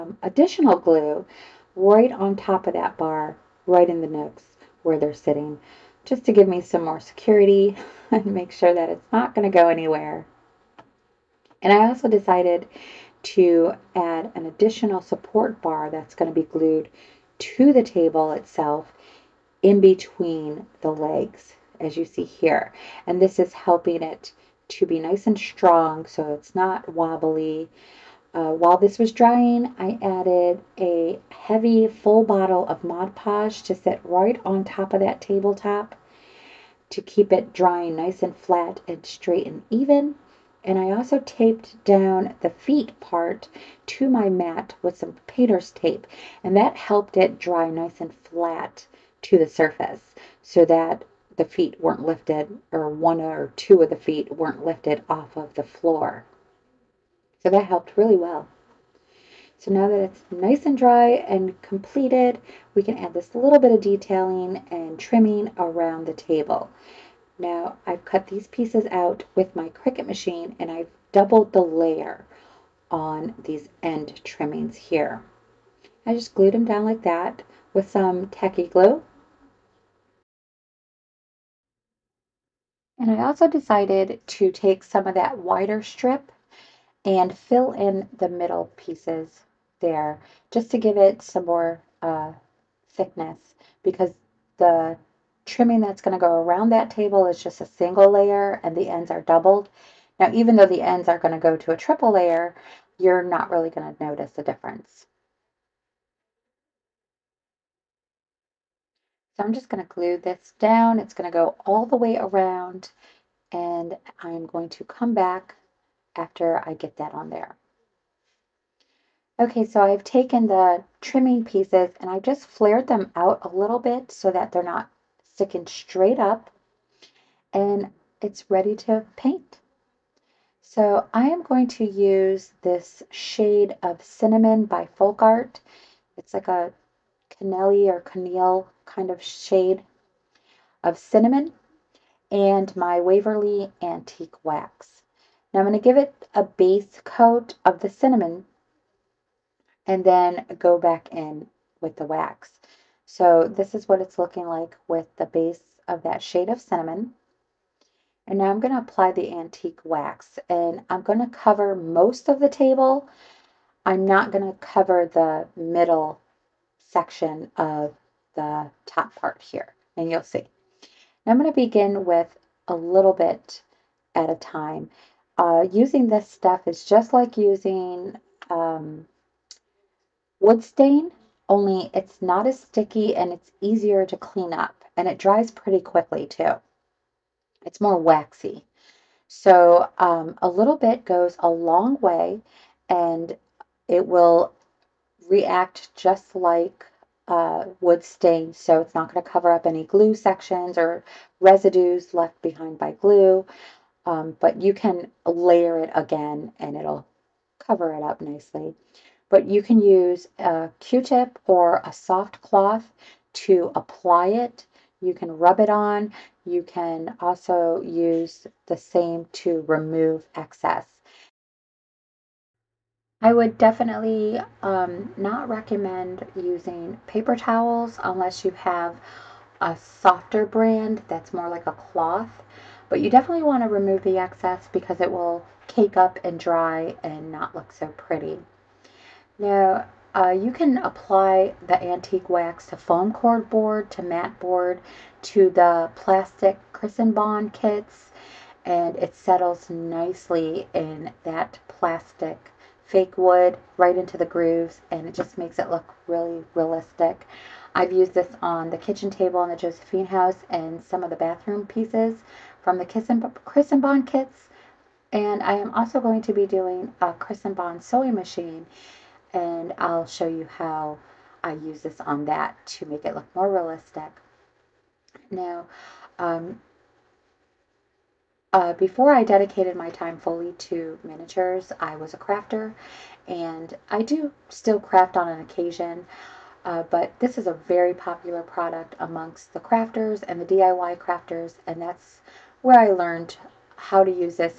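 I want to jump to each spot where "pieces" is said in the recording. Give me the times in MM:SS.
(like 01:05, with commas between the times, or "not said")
01:08, 01:28, 02:01, 04:21.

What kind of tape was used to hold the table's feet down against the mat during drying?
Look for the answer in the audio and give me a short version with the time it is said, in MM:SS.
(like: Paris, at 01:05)
Painter's tape, at 00:45.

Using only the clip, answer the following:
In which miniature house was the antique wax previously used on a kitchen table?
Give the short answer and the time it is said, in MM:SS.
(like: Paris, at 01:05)
Josephine house, at 04:19.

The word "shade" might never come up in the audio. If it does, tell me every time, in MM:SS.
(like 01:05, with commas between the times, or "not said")
02:13, 02:19, 02:36.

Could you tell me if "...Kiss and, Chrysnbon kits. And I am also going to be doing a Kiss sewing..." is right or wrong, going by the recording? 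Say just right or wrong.
wrong.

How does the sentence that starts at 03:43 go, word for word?
I would definitely um, not recommend using paper towels unless you have a softer brand that's more like a cloth.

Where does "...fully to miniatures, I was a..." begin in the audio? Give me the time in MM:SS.
04:40.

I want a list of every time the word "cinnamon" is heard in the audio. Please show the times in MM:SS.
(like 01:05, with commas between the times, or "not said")
02:14, 02:20, 02:27, 02:36.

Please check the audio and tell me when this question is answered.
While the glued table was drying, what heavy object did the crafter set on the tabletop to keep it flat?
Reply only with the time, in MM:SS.
00:31.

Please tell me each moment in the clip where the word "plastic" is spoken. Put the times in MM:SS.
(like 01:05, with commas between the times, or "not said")
04:05, 04:11.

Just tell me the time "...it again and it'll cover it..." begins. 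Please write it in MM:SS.
03:25.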